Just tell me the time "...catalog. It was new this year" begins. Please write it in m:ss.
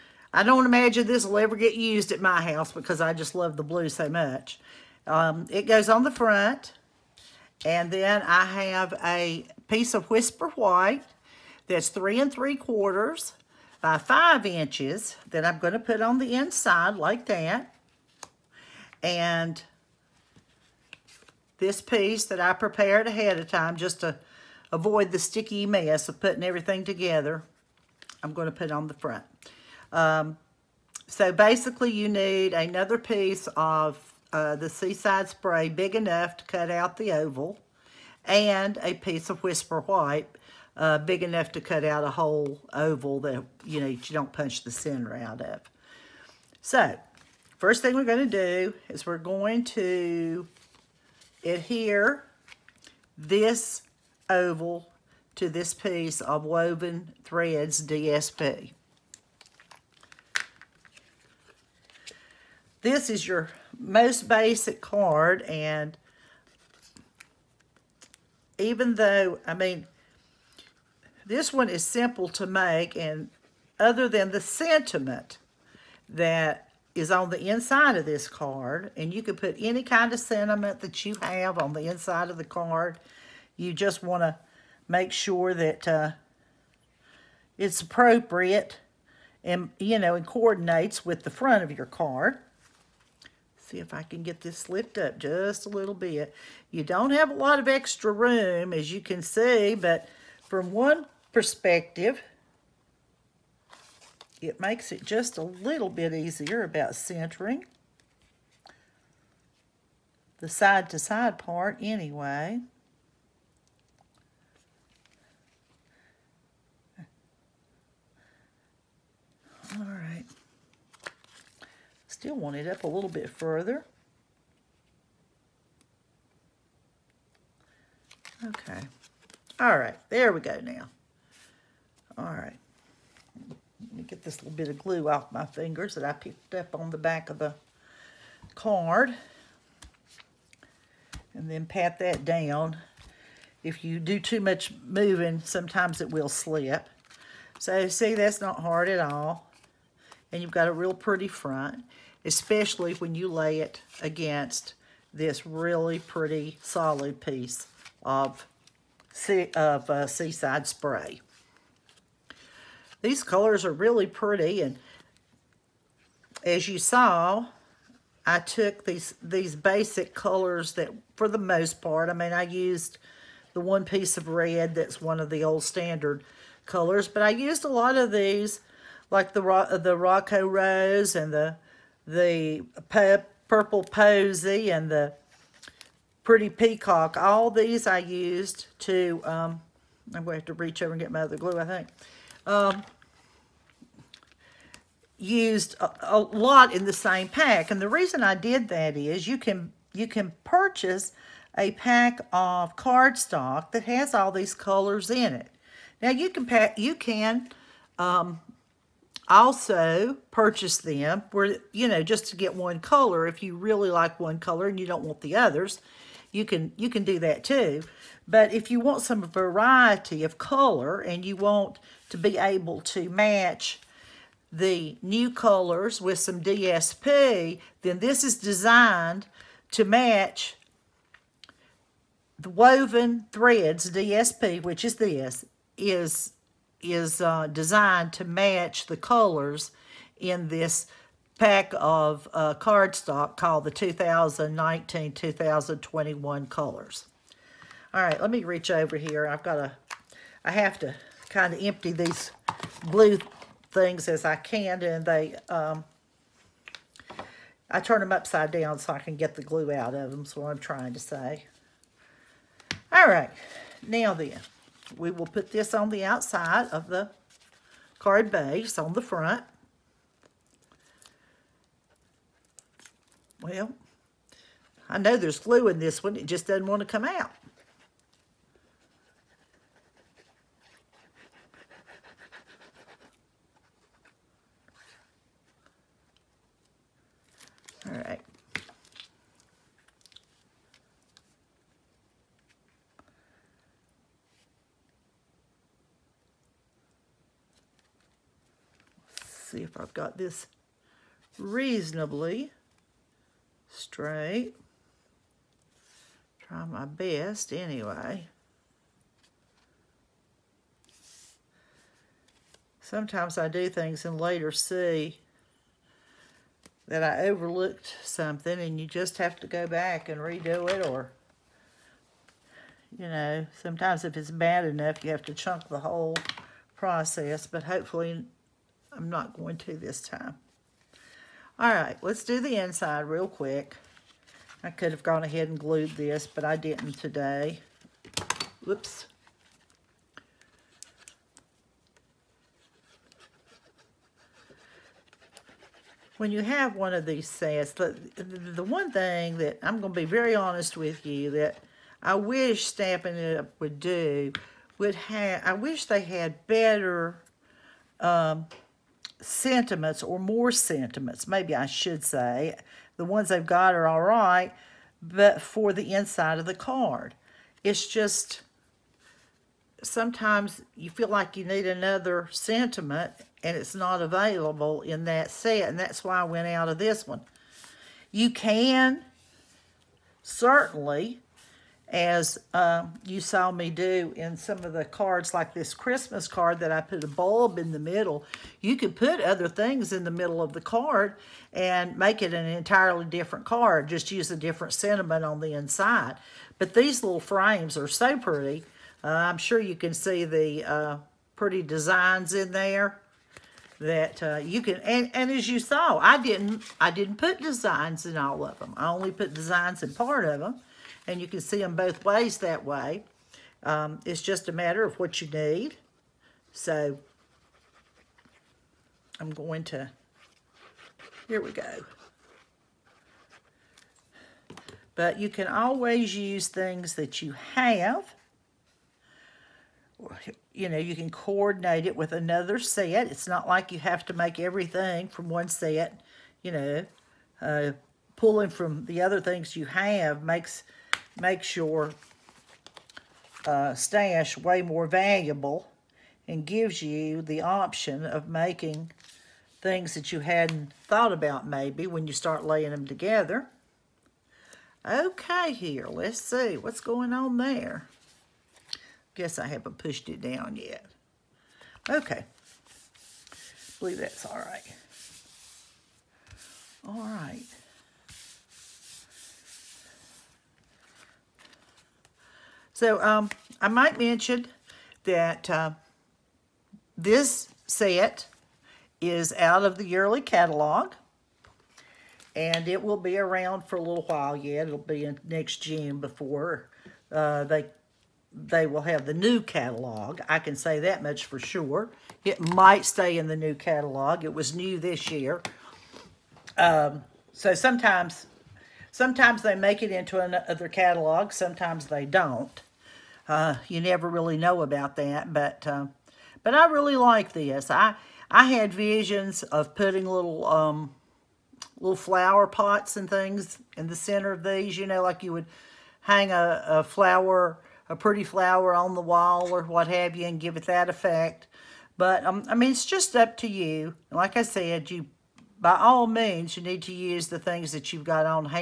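8:13.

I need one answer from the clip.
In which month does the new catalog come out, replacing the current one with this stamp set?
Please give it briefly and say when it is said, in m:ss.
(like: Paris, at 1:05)
June, at 8:05.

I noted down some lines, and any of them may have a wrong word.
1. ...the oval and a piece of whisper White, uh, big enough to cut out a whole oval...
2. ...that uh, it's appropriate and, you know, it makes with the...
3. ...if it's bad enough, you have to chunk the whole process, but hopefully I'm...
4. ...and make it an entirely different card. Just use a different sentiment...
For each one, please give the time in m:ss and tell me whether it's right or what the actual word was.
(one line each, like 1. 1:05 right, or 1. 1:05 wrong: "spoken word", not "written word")
1. 0:36 right
2. 1:25 wrong: "coordinates", not "makes"
3. 5:24 right
4. 6:31 right.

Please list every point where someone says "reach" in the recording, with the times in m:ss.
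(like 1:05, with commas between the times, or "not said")
3:10, 4:08.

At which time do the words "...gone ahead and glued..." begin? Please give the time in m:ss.
5:35.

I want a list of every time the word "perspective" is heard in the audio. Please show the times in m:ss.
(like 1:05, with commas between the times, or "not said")
1:41.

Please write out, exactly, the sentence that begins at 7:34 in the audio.
Okay, here, let's see what's going on there.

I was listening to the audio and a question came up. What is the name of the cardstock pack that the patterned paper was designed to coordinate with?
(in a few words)
2019-2021 colors.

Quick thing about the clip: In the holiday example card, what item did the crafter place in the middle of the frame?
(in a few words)
a bulb.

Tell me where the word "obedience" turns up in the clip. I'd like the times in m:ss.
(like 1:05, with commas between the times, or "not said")
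not said.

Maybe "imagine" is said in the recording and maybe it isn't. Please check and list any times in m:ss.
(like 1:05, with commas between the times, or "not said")
0:00.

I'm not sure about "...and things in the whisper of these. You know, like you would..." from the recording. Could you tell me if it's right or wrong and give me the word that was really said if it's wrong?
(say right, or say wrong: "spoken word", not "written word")
wrong: "center", not "whisper".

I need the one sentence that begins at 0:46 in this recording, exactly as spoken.
So, first thing we're going to do is we're going to adhere this oval to this piece of woven threads DSP.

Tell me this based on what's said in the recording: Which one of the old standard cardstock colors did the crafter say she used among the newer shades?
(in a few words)
red.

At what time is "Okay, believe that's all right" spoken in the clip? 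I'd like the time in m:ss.
7:41.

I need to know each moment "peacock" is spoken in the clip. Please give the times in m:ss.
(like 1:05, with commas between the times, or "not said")
3:06.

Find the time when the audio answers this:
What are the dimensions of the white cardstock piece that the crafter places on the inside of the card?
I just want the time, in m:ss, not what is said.
0:11.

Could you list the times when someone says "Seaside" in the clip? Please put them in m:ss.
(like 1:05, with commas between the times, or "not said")
0:34, 2:40.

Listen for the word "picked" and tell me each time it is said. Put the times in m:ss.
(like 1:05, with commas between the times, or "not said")
2:16.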